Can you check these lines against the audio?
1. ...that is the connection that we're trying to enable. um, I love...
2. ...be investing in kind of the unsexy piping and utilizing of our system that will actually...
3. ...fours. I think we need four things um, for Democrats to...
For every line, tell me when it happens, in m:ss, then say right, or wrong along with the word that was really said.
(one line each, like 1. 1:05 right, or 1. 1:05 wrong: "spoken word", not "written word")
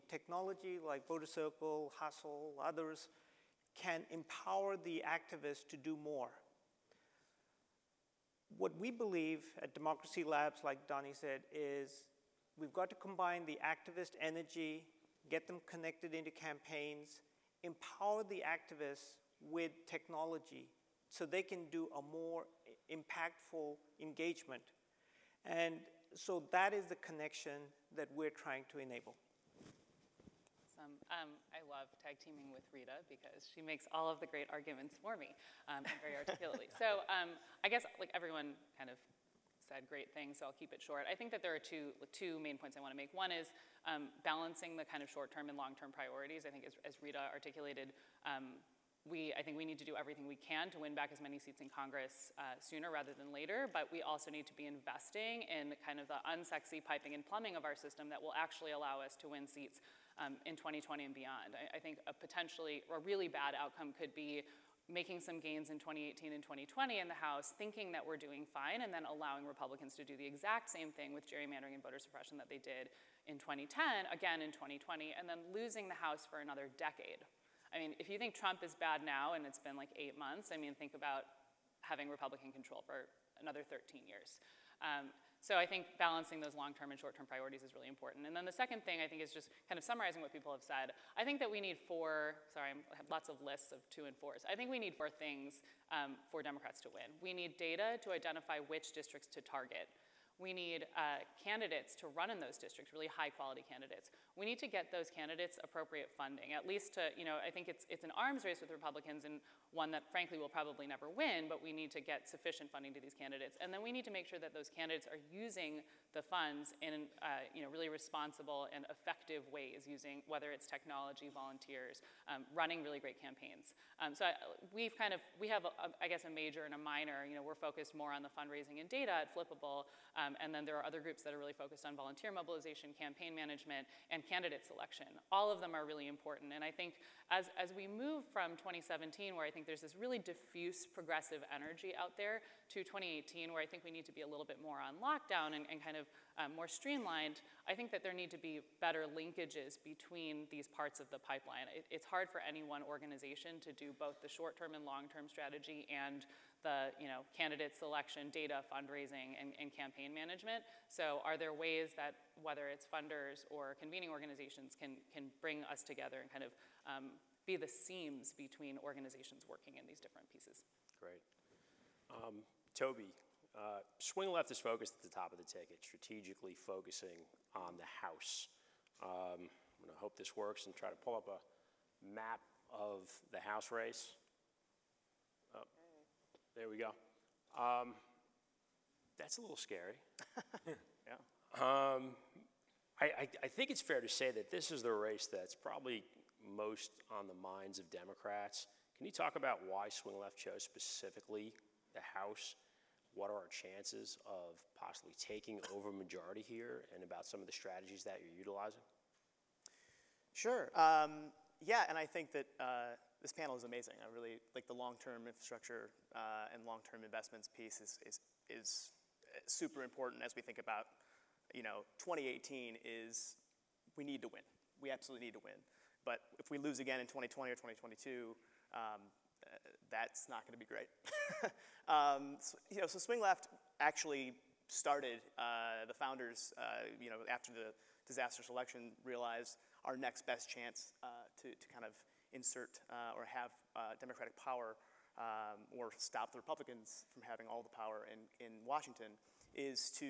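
1. 0:26 right
2. 0:54 wrong: "plumbing", not "utilizing"
3. 1:34 right.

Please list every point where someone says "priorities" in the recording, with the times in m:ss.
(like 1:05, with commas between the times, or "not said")
0:45, 1:27.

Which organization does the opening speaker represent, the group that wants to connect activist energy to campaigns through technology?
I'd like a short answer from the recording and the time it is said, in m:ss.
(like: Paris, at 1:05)
Democracy Labs, at 0:09.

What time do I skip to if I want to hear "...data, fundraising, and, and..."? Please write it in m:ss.
2:38.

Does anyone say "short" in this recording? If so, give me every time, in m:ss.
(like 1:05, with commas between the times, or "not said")
0:40, 0:45, 1:26, 2:34.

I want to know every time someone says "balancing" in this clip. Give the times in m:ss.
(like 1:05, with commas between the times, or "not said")
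0:44, 1:25.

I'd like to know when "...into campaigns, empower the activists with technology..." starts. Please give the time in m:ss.
0:16.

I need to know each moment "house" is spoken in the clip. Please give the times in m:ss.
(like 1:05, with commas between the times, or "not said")
1:07, 1:16, 2:57, 3:03, 3:22.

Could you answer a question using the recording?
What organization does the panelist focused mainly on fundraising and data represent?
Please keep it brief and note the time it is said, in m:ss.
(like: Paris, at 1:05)
Flippable, at 2:09.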